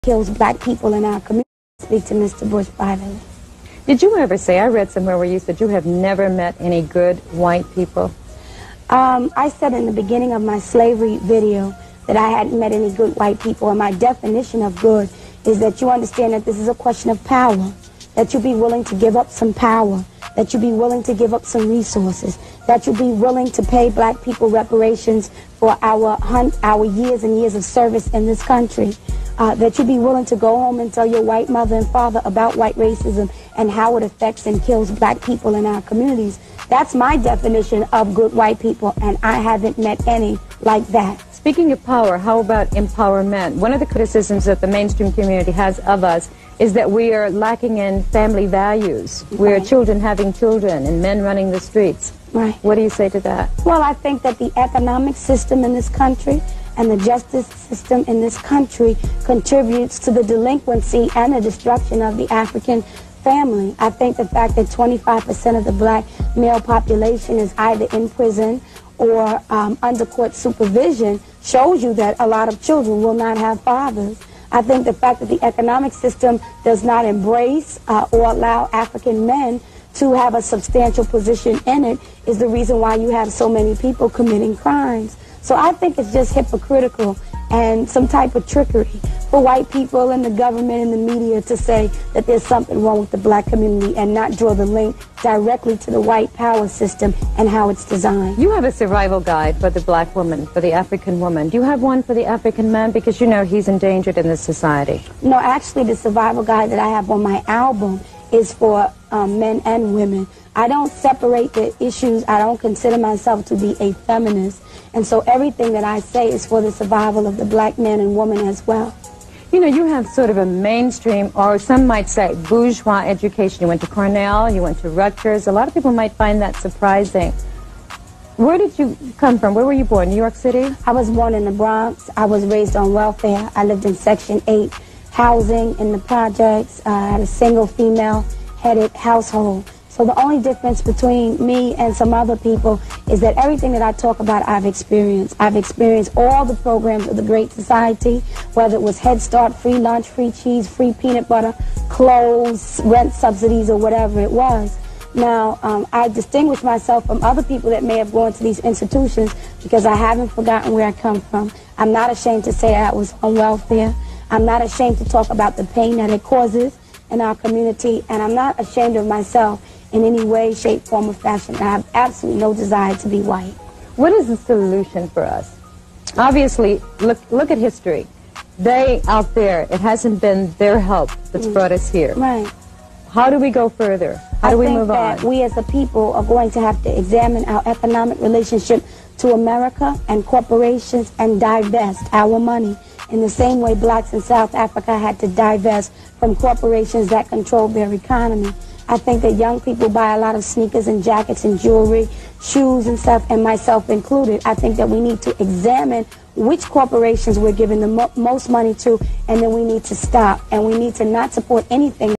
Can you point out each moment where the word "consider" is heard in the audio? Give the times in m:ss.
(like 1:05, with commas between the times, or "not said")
1:52.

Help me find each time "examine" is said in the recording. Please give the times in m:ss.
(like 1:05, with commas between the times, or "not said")
3:06, 3:25.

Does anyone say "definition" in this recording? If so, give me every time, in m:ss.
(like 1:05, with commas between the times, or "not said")
0:13, 0:37.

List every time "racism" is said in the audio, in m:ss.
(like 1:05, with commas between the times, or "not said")
0:32.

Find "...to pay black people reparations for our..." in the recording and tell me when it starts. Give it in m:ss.
0:23.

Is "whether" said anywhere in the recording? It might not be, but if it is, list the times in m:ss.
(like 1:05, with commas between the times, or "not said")
2:28.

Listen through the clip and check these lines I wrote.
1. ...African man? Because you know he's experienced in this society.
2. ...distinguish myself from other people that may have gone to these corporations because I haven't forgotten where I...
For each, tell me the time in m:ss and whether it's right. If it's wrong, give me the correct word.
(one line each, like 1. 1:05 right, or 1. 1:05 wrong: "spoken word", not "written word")
1. 1:42 wrong: "endangered", not "experienced"
2. 2:36 wrong: "institutions", not "corporations".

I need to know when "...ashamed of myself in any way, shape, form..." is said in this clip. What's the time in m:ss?
2:48.